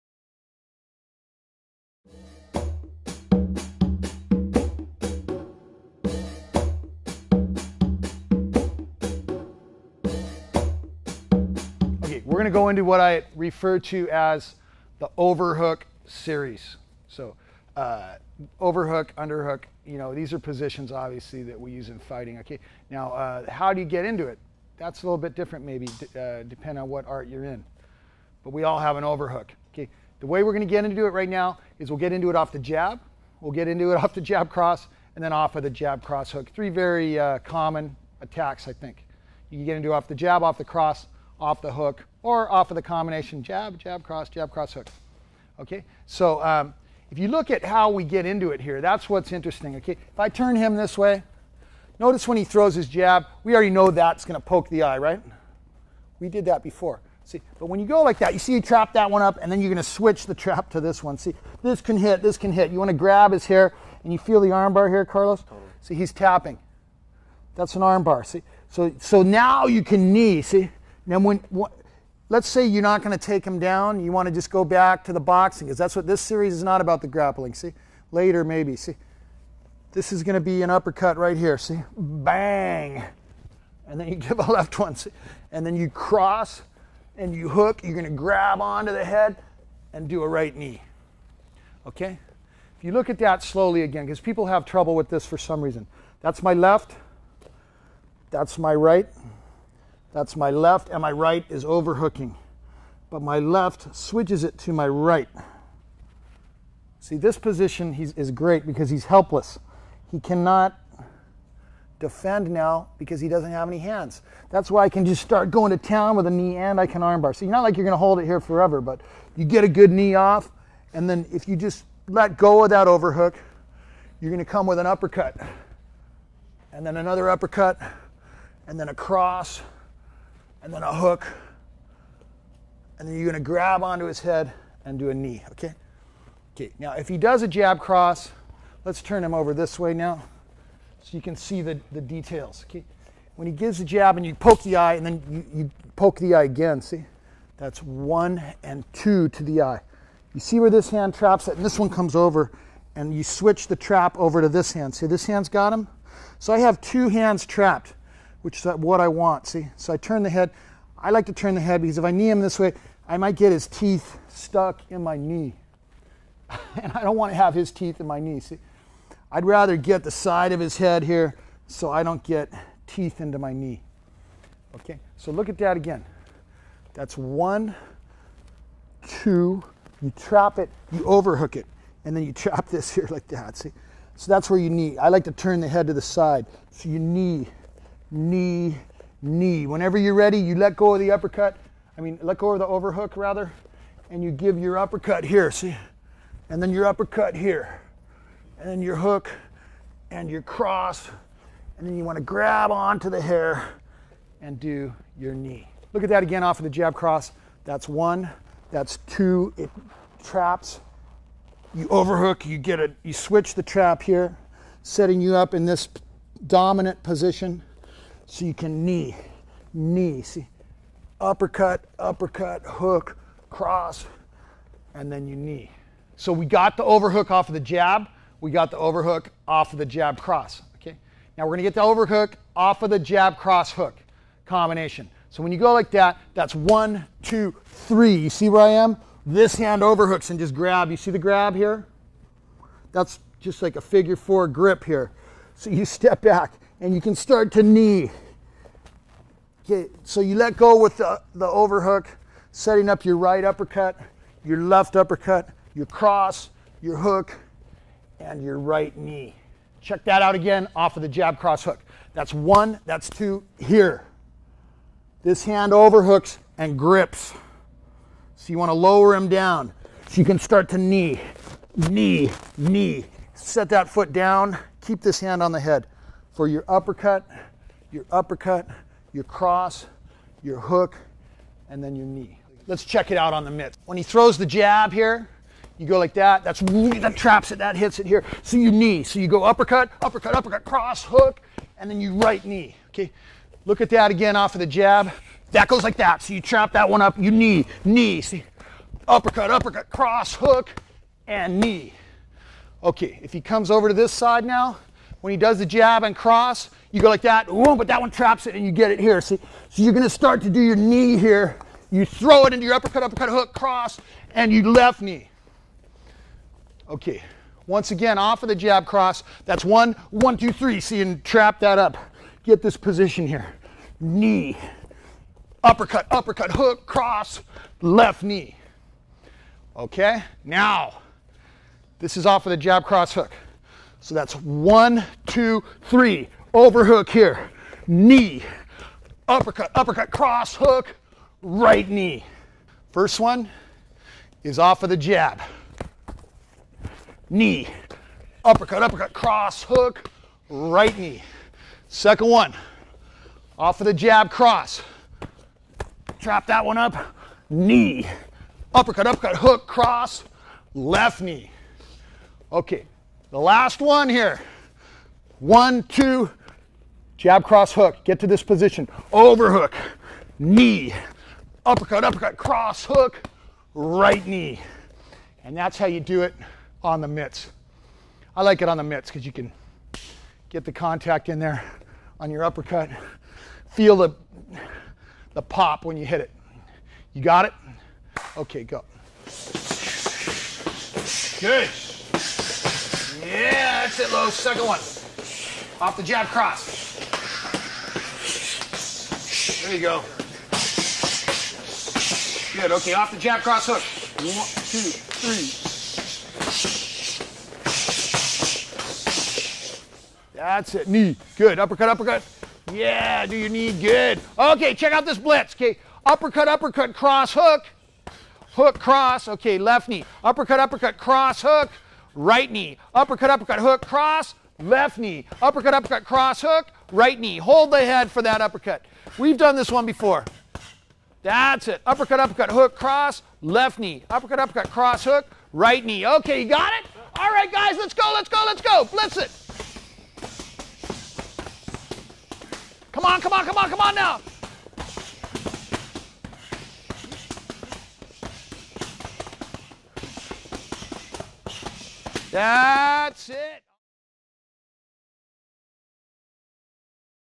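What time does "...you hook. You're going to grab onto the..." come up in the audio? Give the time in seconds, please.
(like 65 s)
87 s.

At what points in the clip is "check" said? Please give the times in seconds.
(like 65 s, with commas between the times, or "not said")
259 s, 282 s, 414 s.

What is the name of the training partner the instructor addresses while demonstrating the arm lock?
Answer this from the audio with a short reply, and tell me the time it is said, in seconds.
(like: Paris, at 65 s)
Carlos, at 65 s.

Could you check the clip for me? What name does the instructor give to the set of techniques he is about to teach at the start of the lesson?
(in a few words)
overhook series.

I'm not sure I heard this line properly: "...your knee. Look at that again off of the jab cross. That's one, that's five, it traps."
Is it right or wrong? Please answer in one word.
wrong.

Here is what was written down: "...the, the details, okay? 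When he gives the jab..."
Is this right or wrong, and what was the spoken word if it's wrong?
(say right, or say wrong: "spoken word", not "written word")
right.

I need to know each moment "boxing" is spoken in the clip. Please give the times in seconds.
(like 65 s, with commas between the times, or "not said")
75 s.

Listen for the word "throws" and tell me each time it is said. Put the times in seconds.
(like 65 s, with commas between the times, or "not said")
52 s, 284 s, 312 s.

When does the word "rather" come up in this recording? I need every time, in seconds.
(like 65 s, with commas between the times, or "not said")
169 s, 193 s.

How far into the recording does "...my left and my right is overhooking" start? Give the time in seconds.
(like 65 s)
100 s.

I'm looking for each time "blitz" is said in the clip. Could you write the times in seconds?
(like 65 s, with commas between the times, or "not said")
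415 s, 438 s.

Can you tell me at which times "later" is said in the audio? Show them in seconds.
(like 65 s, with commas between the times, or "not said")
78 s.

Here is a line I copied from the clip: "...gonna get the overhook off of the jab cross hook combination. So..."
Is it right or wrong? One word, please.
right.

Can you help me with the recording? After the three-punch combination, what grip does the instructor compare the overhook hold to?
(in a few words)
figure four grip.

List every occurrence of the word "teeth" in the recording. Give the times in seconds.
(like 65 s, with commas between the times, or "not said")
163 s, 167 s, 172 s.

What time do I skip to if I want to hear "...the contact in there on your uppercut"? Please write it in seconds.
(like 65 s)
380 s.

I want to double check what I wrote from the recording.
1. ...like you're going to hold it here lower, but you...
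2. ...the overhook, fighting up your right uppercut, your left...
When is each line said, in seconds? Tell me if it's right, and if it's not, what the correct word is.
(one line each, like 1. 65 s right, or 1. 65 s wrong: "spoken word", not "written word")
1. 117 s wrong: "forever", not "lower"
2. 251 s wrong: "setting", not "fighting".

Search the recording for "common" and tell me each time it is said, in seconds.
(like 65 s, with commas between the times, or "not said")
37 s.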